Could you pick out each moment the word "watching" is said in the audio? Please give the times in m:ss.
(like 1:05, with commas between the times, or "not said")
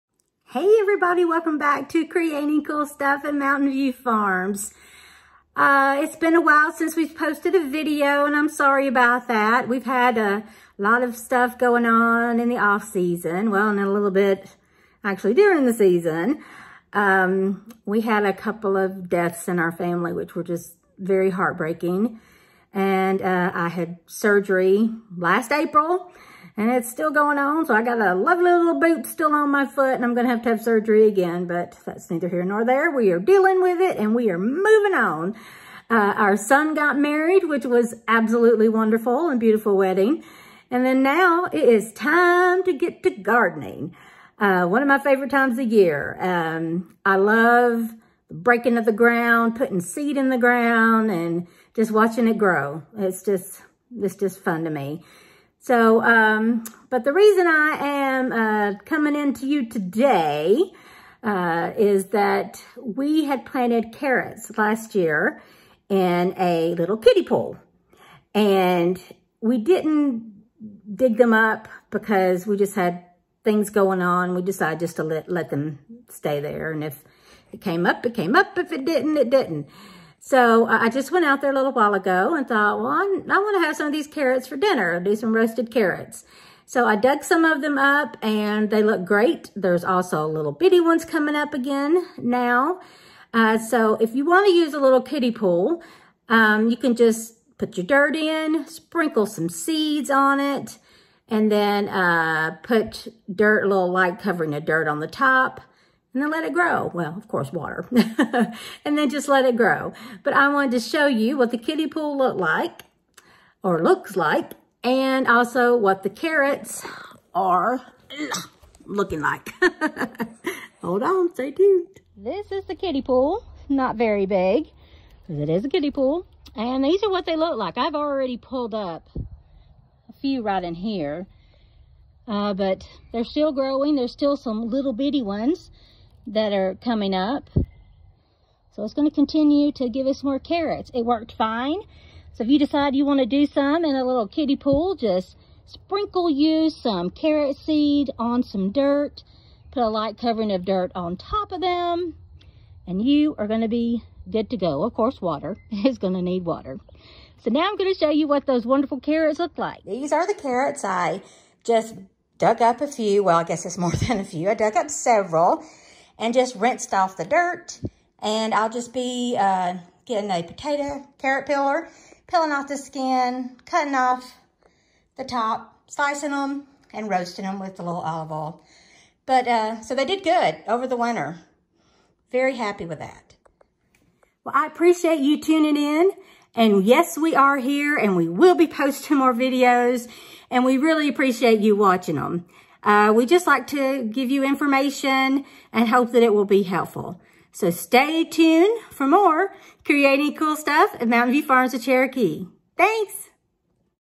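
0:51, 3:11.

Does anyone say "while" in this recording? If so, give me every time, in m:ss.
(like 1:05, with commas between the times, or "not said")
0:06, 1:21.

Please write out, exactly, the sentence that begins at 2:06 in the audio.
And these are what they look like.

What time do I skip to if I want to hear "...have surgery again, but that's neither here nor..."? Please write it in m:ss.
0:30.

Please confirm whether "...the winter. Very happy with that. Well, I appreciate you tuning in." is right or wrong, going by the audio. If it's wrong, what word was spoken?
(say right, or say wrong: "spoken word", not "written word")
right.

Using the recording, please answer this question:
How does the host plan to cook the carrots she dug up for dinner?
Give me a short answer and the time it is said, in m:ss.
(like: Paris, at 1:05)
Roasted, at 1:25.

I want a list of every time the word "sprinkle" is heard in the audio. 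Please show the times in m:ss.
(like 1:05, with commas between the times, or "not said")
1:38, 2:25.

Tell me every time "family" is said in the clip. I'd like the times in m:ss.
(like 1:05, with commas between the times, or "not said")
0:19.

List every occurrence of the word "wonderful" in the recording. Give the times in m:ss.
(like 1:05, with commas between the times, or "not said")
0:38, 2:38.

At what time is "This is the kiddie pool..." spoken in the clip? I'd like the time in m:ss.
2:02.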